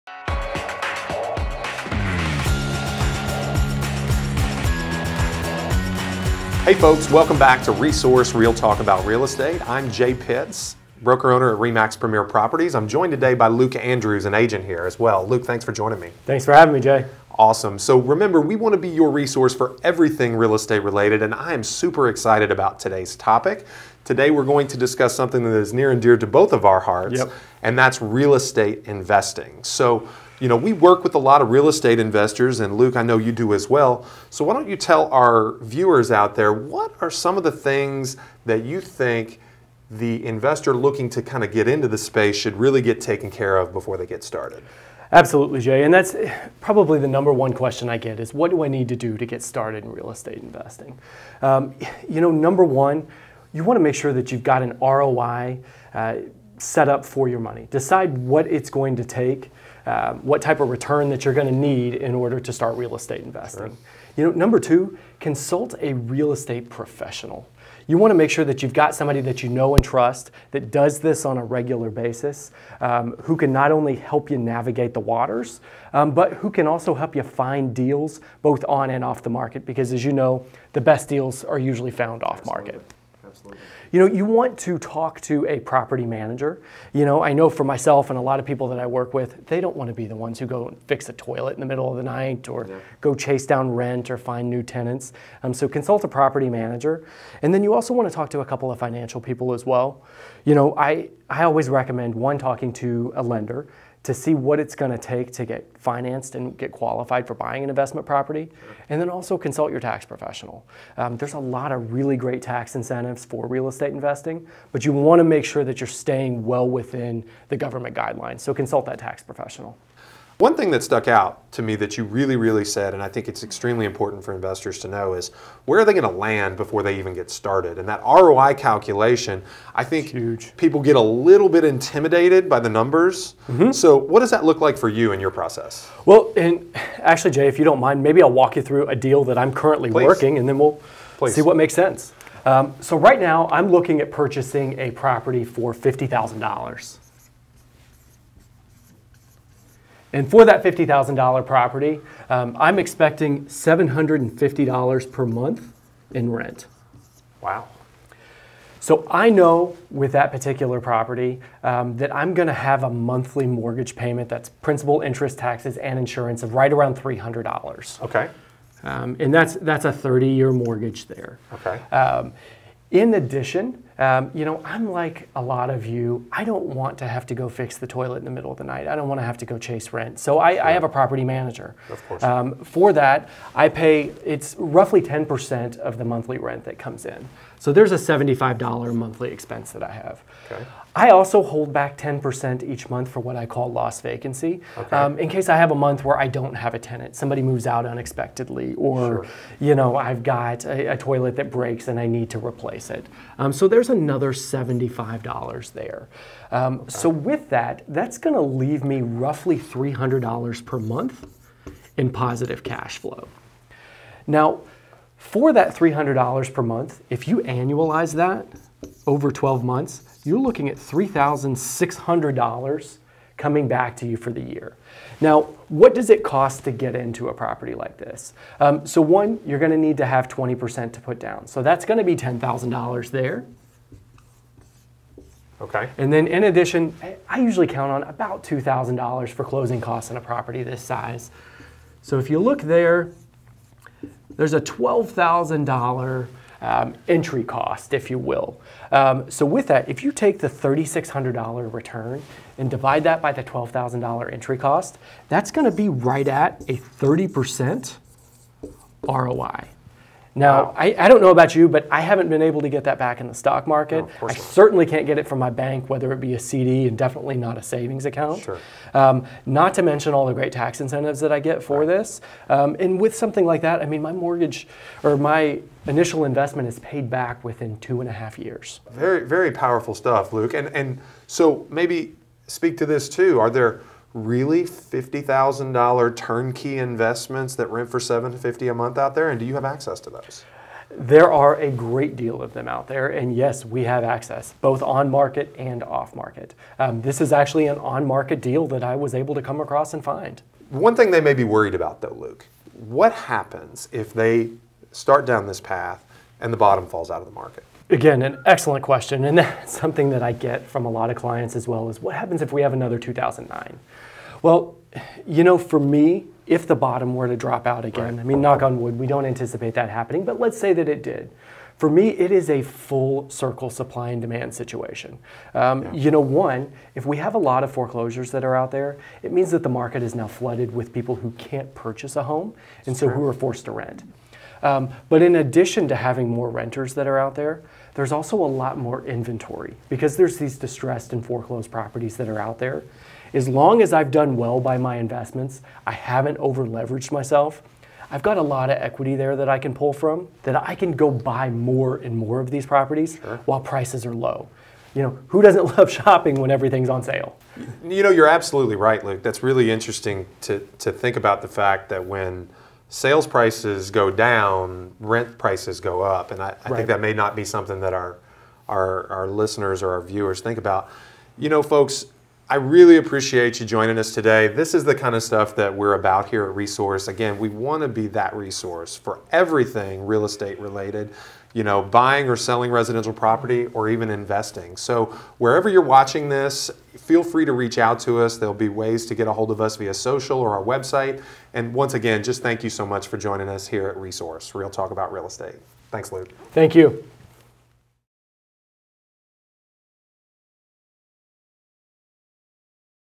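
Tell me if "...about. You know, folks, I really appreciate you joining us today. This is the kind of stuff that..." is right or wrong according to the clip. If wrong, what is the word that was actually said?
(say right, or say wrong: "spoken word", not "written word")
right.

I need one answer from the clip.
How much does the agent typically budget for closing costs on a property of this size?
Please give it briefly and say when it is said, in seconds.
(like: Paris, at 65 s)
$2,000, at 238 s.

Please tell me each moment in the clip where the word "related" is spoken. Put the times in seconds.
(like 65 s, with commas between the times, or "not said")
20 s, 380 s.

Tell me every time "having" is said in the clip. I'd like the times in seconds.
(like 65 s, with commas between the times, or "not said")
16 s, 335 s.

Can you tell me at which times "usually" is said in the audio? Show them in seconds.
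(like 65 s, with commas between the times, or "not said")
81 s, 237 s.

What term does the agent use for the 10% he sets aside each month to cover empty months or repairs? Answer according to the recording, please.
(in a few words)
lost vacancy.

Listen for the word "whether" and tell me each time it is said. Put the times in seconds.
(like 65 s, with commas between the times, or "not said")
265 s.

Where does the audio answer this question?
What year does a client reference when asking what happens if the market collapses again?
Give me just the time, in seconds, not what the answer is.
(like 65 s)
312 s.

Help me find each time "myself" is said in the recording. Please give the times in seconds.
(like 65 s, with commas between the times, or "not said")
87 s, 347 s.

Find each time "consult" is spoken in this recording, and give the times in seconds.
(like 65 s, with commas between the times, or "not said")
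65 s, 95 s, 109 s, 118 s.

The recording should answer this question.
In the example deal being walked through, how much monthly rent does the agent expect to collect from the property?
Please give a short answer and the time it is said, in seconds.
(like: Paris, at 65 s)
$750, at 153 s.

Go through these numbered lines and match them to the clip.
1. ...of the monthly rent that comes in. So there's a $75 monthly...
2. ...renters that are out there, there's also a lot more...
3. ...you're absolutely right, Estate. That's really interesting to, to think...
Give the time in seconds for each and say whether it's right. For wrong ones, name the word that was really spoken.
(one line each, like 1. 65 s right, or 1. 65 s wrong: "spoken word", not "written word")
1. 185 s right
2. 336 s right
3. 358 s wrong: "Luke", not "Estate".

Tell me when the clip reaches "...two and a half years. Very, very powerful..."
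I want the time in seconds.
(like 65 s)
277 s.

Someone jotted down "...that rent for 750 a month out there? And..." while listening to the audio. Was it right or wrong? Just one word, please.
right.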